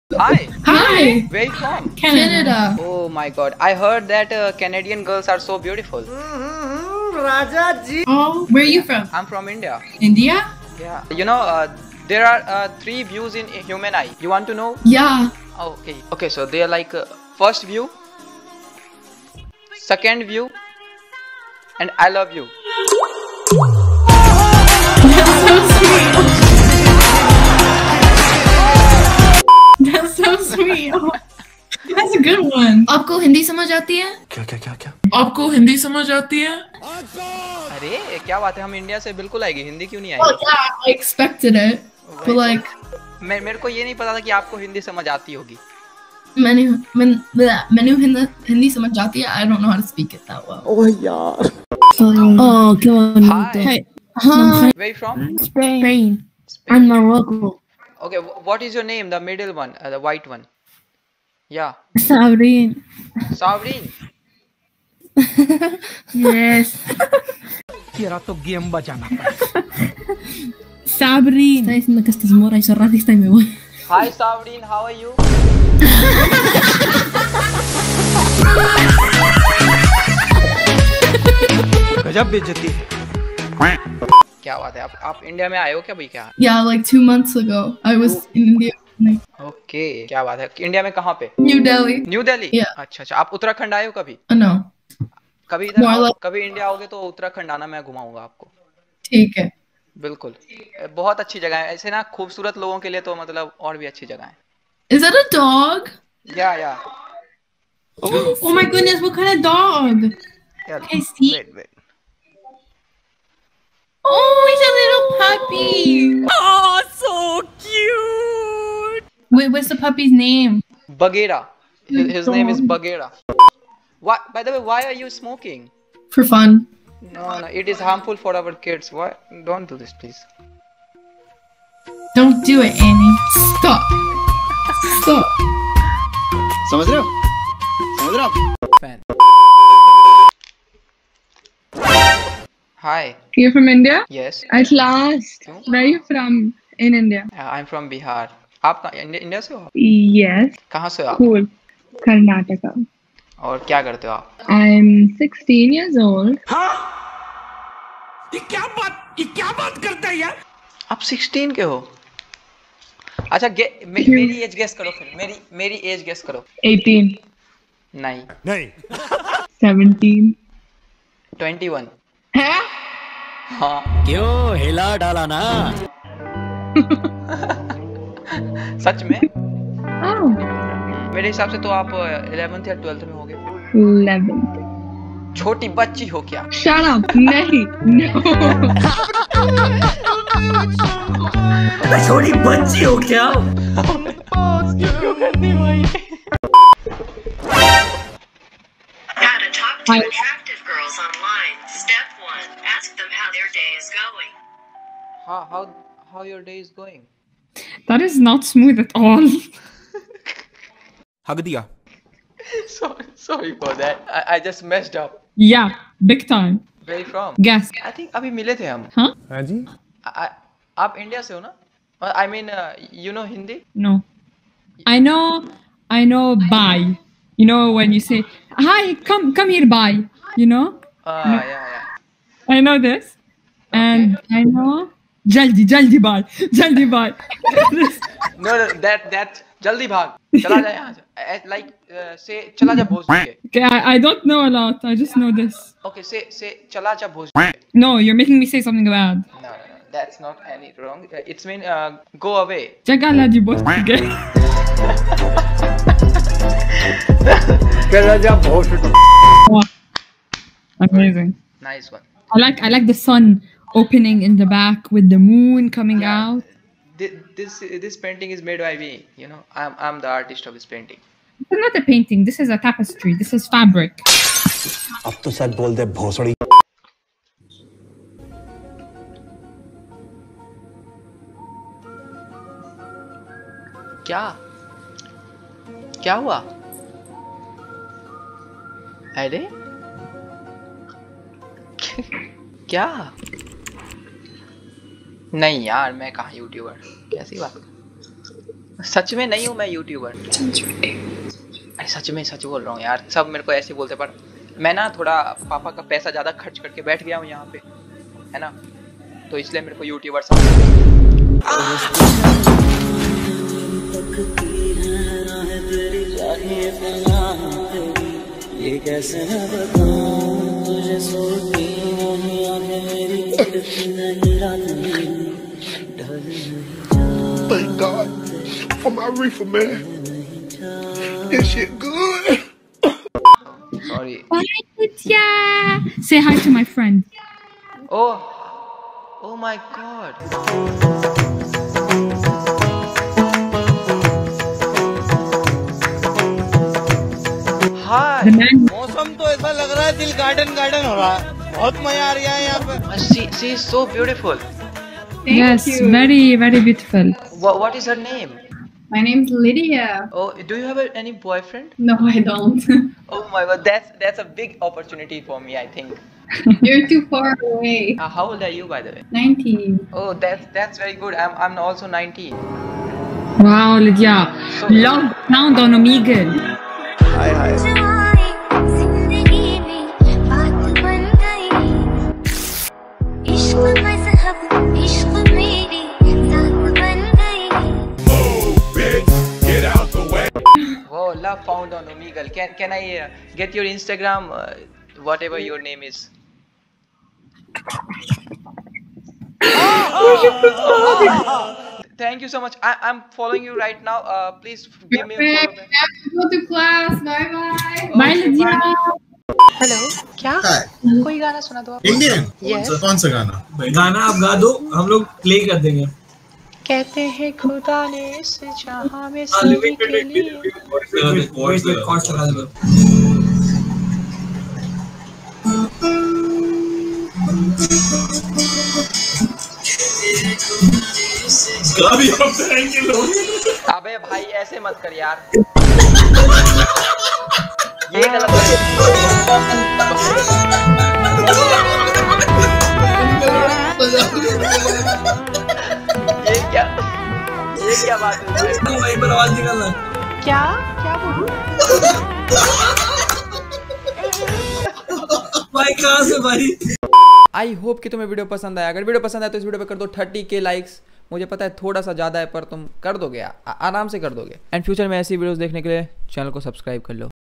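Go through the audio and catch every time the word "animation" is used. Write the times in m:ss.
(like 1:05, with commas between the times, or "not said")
not said.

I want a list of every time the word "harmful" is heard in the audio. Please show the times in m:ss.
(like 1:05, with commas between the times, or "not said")
2:07.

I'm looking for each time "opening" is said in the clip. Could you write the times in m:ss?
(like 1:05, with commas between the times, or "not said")
4:23.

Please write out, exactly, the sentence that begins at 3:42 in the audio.
I mean, uh, you know Hindi?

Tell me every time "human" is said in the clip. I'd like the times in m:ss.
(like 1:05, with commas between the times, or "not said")
0:13.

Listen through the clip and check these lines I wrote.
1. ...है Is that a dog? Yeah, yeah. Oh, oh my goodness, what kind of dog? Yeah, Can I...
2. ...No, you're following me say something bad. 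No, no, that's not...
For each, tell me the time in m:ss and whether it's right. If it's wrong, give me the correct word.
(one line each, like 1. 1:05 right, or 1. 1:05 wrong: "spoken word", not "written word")
1. 1:44 right
2. 4:07 wrong: "making", not "following".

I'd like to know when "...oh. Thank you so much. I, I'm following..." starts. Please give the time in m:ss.
6:40.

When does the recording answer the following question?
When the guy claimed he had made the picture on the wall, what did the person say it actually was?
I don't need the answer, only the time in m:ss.
4:32.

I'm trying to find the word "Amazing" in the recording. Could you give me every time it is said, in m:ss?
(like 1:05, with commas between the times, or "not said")
4:20.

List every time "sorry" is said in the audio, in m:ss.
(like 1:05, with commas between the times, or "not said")
3:33, 5:33.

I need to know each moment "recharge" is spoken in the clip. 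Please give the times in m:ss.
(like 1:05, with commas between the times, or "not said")
not said.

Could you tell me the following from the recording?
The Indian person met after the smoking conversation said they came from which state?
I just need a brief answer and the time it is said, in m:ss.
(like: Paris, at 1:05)
Bihar, at 2:27.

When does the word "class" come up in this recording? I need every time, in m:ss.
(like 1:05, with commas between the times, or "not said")
6:46.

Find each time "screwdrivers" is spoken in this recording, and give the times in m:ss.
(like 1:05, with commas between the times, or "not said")
not said.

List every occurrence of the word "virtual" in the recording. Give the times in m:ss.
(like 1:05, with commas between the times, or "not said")
not said.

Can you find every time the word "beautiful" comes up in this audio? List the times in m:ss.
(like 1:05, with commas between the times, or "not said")
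0:05, 5:56.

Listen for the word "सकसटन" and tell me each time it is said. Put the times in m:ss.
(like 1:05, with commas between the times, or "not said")
2:35, 2:41.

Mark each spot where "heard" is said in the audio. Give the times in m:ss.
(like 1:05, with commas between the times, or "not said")
0:03.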